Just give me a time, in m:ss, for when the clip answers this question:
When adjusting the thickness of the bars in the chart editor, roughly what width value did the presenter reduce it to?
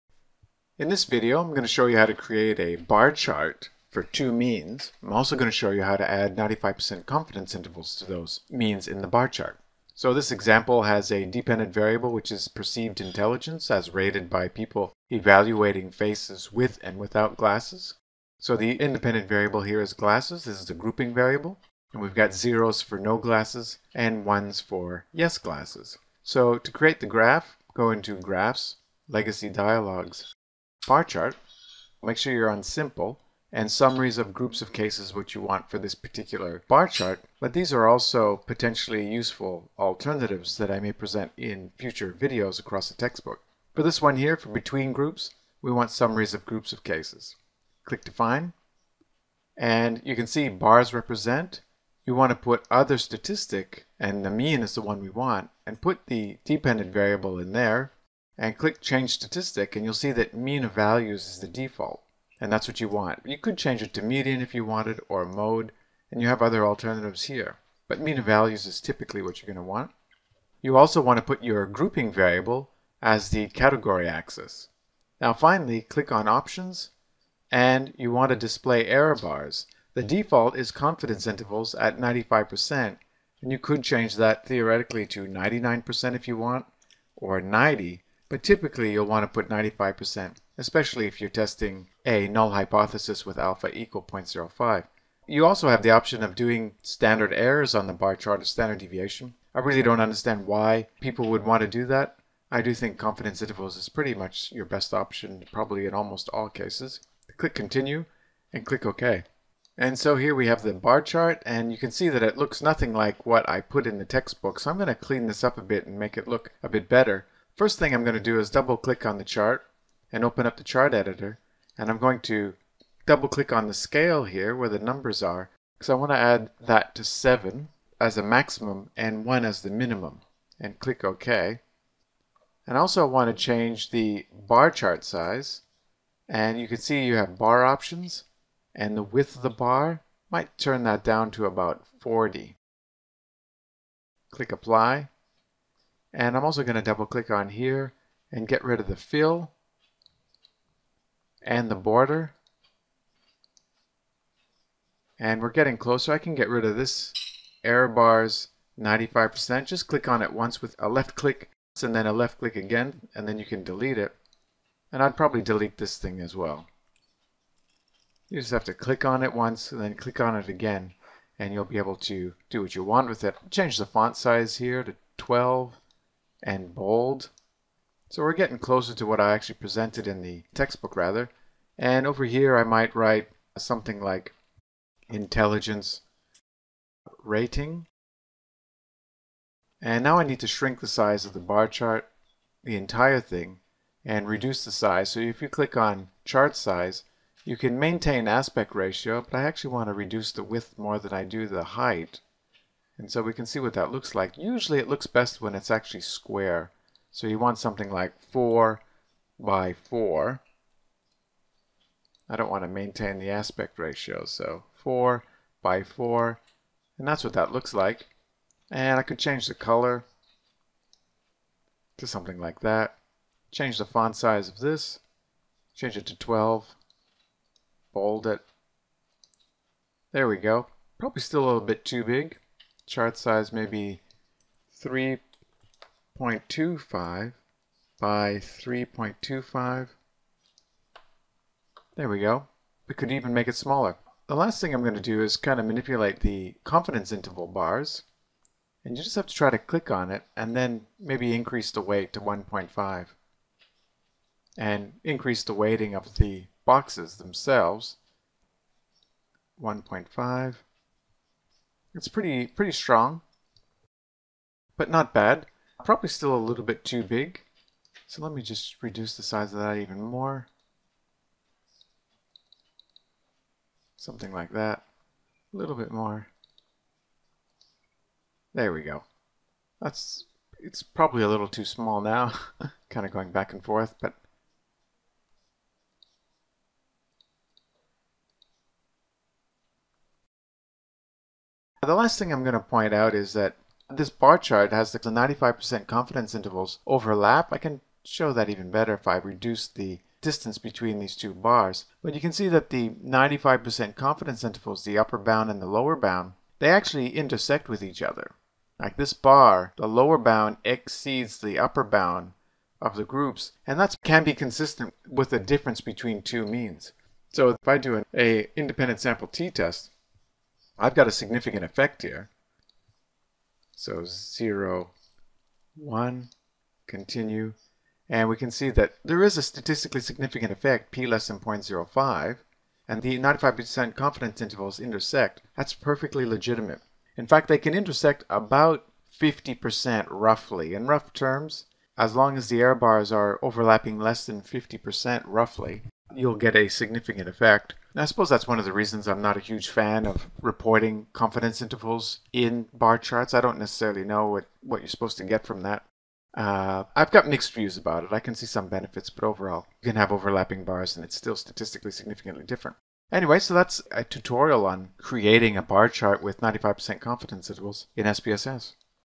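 2:21.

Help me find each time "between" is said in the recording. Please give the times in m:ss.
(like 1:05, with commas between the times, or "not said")
0:44, 5:00, 5:15.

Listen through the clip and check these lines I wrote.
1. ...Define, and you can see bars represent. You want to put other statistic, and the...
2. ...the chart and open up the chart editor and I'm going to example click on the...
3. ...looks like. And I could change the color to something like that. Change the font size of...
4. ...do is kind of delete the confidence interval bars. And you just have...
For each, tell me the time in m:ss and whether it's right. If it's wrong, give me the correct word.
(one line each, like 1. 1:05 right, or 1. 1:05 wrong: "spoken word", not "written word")
1. 0:48 right
2. 1:59 wrong: "double", not "example"
3. 3:37 right
4. 4:04 wrong: "manipulate", not "delete".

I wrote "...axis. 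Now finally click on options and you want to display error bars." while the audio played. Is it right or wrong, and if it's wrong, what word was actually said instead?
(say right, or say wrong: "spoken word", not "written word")
right.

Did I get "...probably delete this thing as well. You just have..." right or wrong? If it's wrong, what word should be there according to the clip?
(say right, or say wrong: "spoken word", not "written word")
right.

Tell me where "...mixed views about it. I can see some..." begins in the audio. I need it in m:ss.
5:57.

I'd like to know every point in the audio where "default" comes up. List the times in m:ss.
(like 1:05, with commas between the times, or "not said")
1:01, 1:20.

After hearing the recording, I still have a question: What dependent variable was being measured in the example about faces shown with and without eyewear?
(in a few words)
Perceived intelligence.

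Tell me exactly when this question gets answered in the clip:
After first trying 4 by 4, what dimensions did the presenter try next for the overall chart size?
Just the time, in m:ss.
3:54.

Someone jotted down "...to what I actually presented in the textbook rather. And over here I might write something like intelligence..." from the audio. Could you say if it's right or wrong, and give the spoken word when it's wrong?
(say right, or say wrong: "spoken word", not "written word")
right.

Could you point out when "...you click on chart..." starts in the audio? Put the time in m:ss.
3:15.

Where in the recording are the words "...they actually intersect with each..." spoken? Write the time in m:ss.
5:06.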